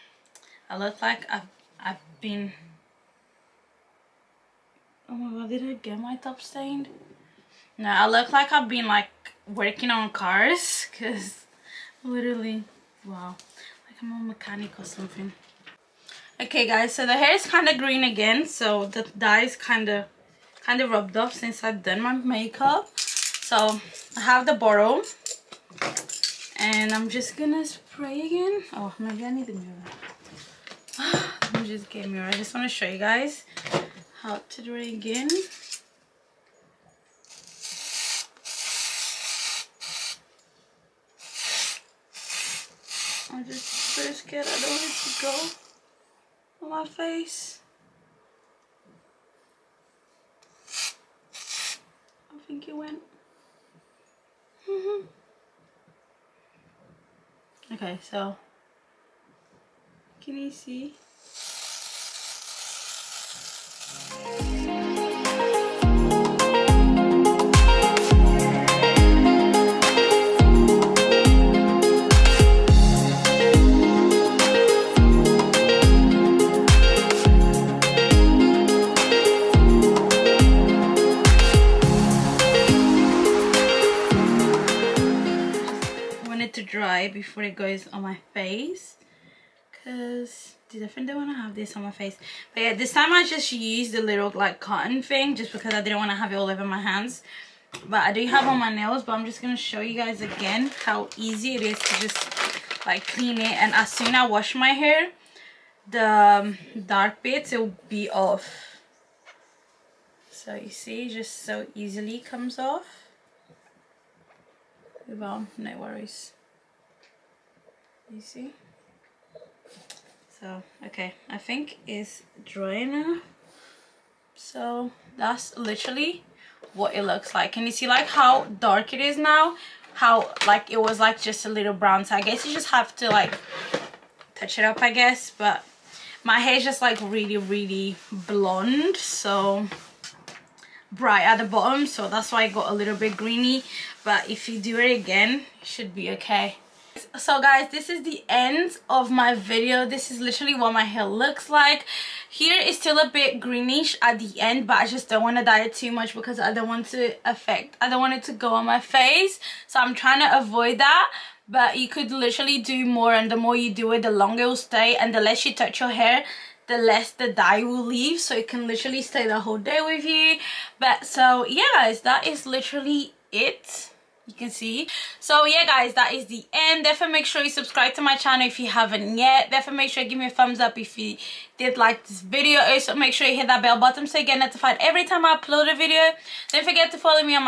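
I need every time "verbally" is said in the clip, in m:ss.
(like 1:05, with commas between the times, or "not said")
not said.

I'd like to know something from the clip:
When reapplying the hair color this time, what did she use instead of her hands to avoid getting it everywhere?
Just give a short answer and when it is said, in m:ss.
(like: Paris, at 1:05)
cotton, at 1:34.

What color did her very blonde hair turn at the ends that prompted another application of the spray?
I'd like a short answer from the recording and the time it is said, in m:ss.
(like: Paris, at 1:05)
green, at 2:23.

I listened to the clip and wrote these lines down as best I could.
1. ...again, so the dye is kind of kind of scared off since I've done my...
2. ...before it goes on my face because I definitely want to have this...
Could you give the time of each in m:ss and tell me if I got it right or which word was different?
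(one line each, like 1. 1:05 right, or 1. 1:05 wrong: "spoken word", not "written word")
1. 0:18 wrong: "rubbed", not "scared"
2. 1:27 right.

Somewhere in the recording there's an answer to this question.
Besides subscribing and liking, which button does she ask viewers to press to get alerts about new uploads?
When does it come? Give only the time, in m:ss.
3:03.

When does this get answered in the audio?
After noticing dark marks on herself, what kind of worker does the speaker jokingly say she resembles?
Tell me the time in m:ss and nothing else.
0:14.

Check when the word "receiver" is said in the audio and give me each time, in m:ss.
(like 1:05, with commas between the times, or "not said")
not said.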